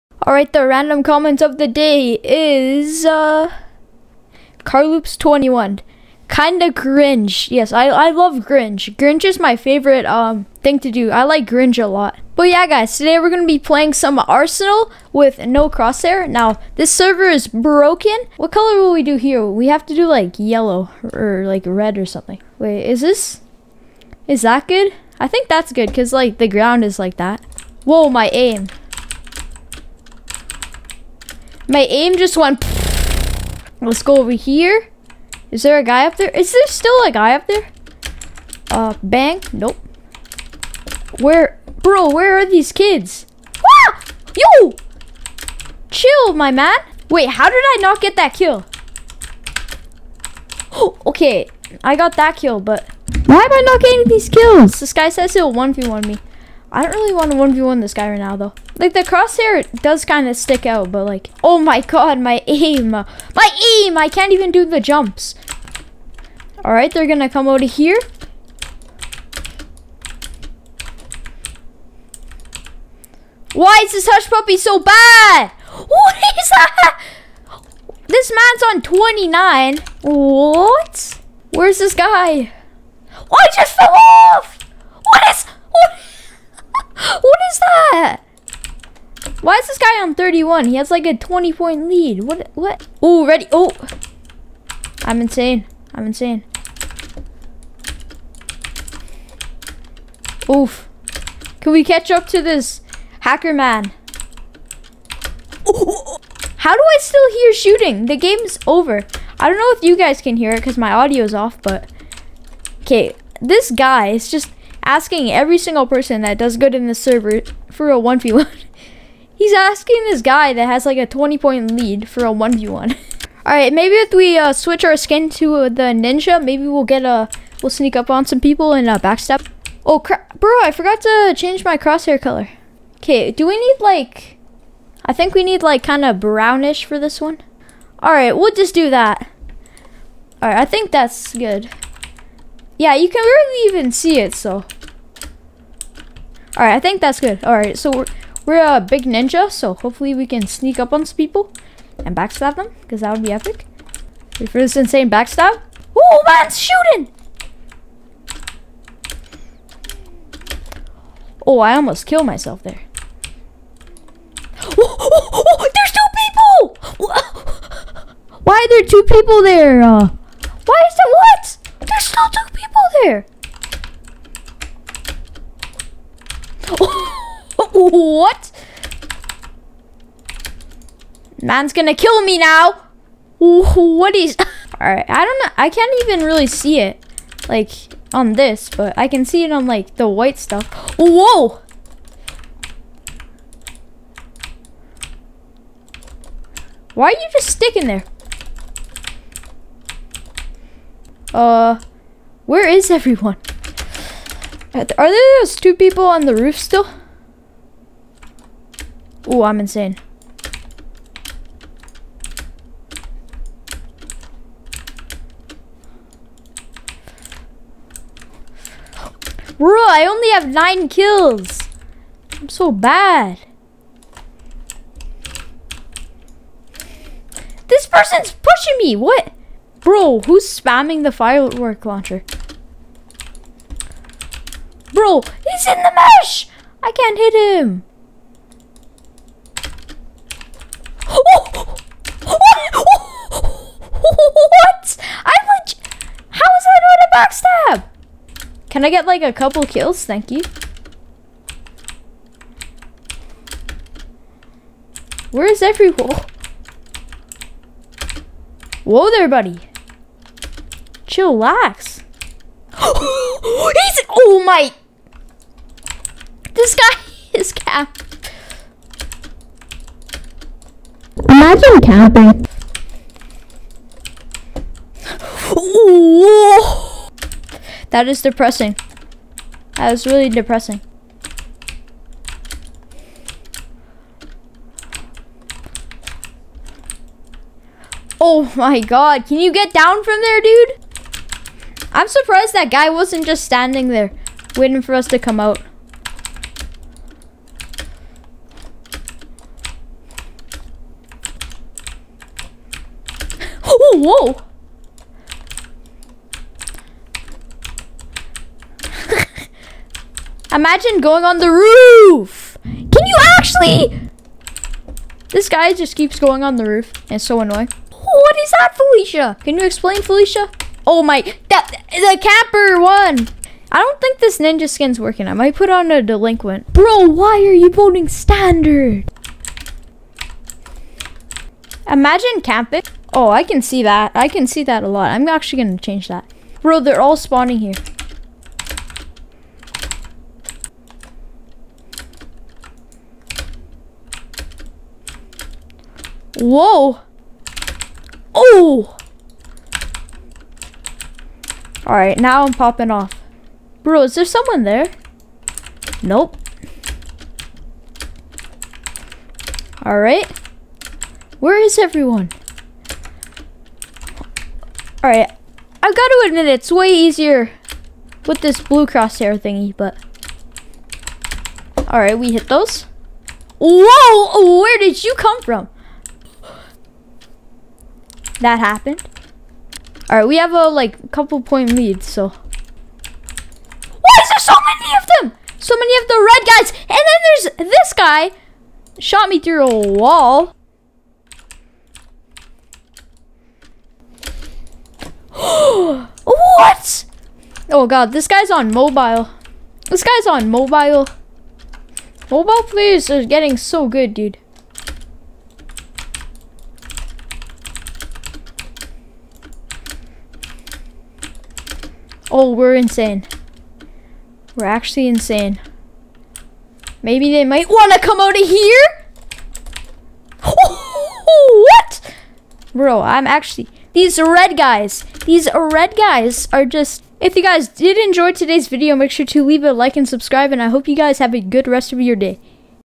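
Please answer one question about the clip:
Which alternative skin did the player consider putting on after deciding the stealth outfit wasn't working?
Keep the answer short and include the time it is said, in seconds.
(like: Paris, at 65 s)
Delinquent, at 326 s.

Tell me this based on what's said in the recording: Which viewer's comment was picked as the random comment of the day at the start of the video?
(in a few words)
Carloops21.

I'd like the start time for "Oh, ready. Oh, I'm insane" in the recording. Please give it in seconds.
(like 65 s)
93 s.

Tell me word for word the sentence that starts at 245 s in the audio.
i like, how is that not a backstab?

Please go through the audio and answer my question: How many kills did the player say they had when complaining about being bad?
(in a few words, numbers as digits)
9.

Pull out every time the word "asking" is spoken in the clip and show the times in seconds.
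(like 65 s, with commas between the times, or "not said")
114 s, 119 s.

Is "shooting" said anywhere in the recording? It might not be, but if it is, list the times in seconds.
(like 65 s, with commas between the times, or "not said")
107 s, 156 s.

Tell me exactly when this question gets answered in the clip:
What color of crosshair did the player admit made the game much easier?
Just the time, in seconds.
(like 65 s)
368 s.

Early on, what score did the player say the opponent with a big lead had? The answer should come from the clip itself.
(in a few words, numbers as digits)
31.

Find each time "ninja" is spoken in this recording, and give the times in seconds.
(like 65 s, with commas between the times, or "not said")
125 s, 149 s, 324 s.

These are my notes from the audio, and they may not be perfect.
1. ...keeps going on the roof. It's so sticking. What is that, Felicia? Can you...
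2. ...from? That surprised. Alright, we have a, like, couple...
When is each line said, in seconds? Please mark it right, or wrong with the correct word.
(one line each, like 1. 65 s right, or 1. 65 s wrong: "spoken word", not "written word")
1. 315 s wrong: "annoying", not "sticking"
2. 375 s wrong: "happened", not "surprised".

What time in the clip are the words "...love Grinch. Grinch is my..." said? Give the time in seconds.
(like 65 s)
8 s.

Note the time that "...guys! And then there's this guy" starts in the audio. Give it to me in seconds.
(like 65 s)
386 s.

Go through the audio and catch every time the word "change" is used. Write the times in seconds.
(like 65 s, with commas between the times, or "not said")
131 s, 335 s.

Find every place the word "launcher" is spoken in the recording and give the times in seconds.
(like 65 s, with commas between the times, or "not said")
231 s.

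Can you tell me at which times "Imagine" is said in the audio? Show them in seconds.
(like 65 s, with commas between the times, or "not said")
271 s, 310 s, 331 s.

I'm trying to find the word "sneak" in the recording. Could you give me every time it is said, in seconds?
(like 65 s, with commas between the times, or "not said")
127 s, 150 s.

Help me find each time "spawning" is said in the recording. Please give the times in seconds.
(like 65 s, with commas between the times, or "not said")
337 s.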